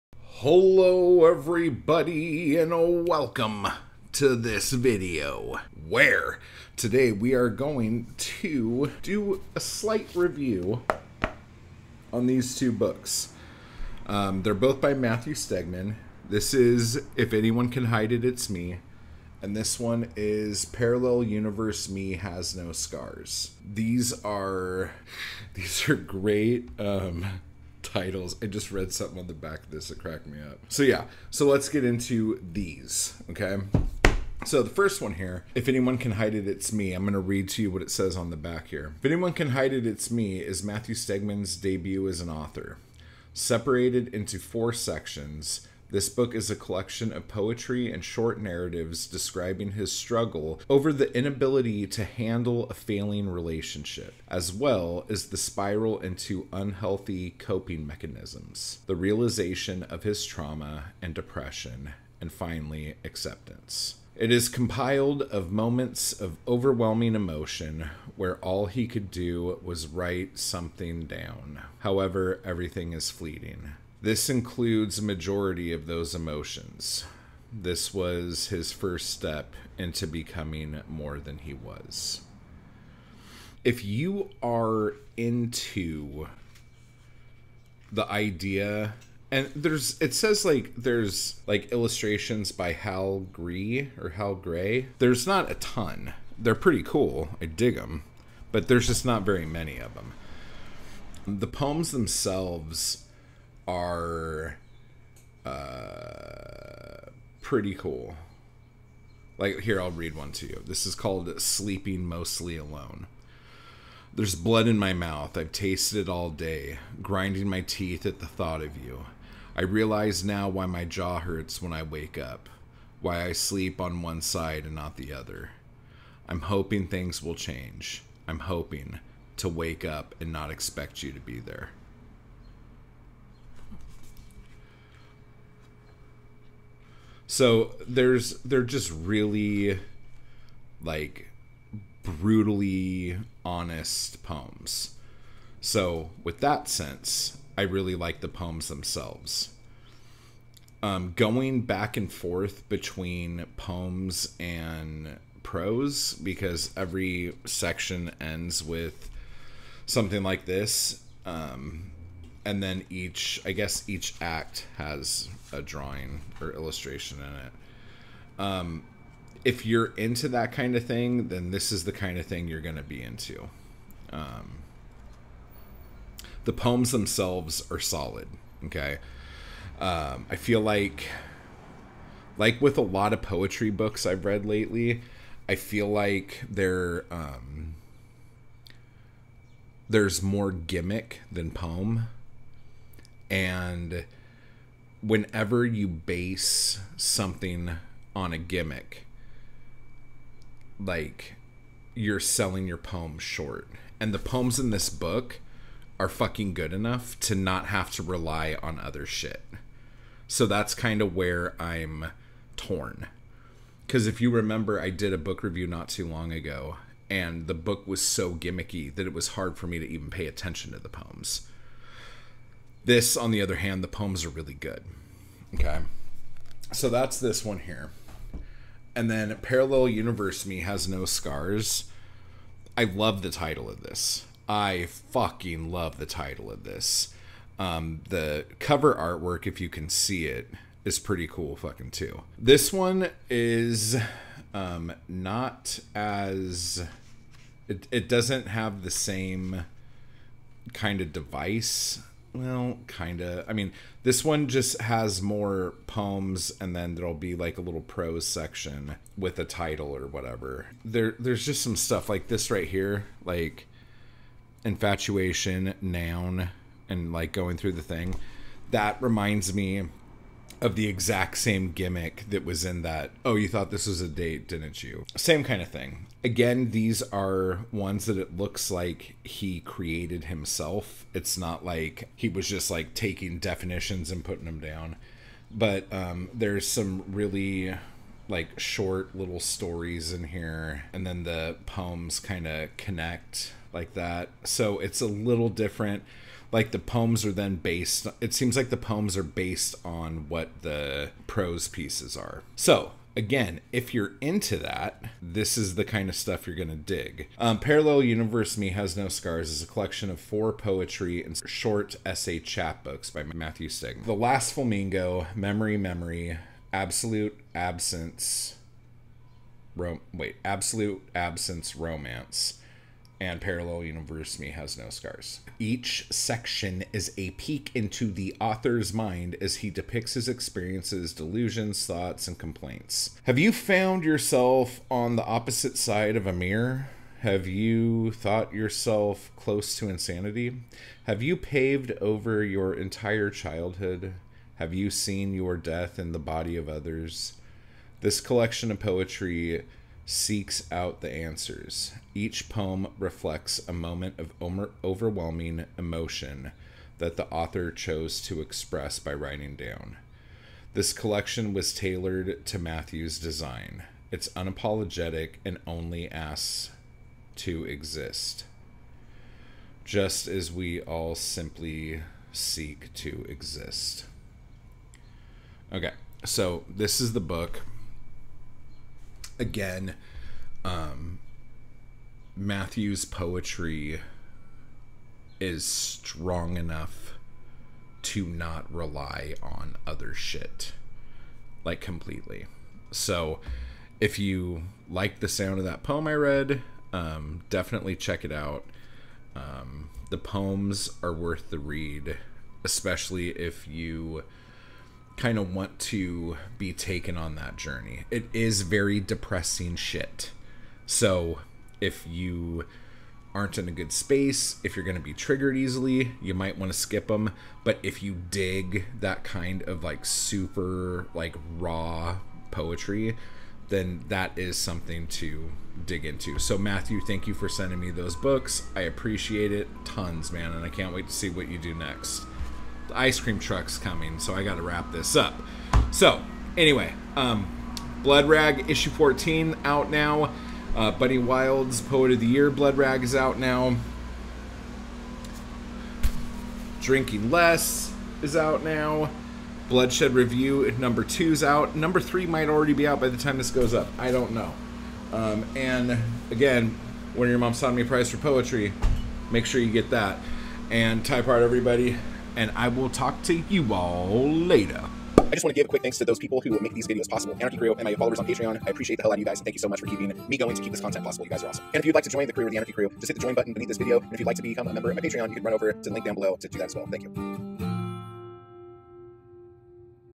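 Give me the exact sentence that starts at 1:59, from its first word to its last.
I realize now why my jaw hurts when I wake up, why I sleep on one side and not the other.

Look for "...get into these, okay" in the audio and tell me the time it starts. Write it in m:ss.
0:31.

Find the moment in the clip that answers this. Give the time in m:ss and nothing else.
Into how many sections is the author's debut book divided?
0:44.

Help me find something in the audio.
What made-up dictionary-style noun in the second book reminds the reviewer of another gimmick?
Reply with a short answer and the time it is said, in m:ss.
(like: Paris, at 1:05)
Infatuation, at 4:24.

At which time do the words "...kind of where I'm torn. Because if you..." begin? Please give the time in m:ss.
3:30.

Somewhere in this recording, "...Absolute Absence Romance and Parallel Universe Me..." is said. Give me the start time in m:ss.
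5:20.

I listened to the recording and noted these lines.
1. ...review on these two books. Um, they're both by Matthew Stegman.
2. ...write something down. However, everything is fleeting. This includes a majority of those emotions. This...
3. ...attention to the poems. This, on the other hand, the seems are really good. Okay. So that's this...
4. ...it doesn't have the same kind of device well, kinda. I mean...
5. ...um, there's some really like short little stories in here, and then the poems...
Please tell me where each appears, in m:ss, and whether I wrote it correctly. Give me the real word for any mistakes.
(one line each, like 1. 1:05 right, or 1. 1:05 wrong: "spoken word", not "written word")
1. 0:10 right
2. 1:09 right
3. 3:40 wrong: "poems", not "seems"
4. 4:07 right
5. 4:45 right.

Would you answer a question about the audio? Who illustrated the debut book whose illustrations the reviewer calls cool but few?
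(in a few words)
Hal Gree.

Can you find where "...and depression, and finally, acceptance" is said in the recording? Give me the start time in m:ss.
1:01.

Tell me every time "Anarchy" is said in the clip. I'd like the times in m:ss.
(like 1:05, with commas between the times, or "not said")
7:47, 7:52.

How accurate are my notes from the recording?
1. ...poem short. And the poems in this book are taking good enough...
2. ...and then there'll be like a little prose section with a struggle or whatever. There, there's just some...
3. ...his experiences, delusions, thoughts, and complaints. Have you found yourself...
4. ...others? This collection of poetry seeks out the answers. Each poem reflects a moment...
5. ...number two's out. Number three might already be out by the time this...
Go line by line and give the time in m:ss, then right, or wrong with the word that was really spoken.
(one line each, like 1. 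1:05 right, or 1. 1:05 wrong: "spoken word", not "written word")
1. 3:22 wrong: "fucking", not "taking"
2. 4:16 wrong: "title", not "struggle"
3. 5:30 right
4. 5:46 right
5. 7:30 right.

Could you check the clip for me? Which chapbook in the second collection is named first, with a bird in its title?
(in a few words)
The Last Flamingo.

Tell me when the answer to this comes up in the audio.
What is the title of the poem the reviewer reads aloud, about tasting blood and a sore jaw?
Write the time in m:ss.
1:51.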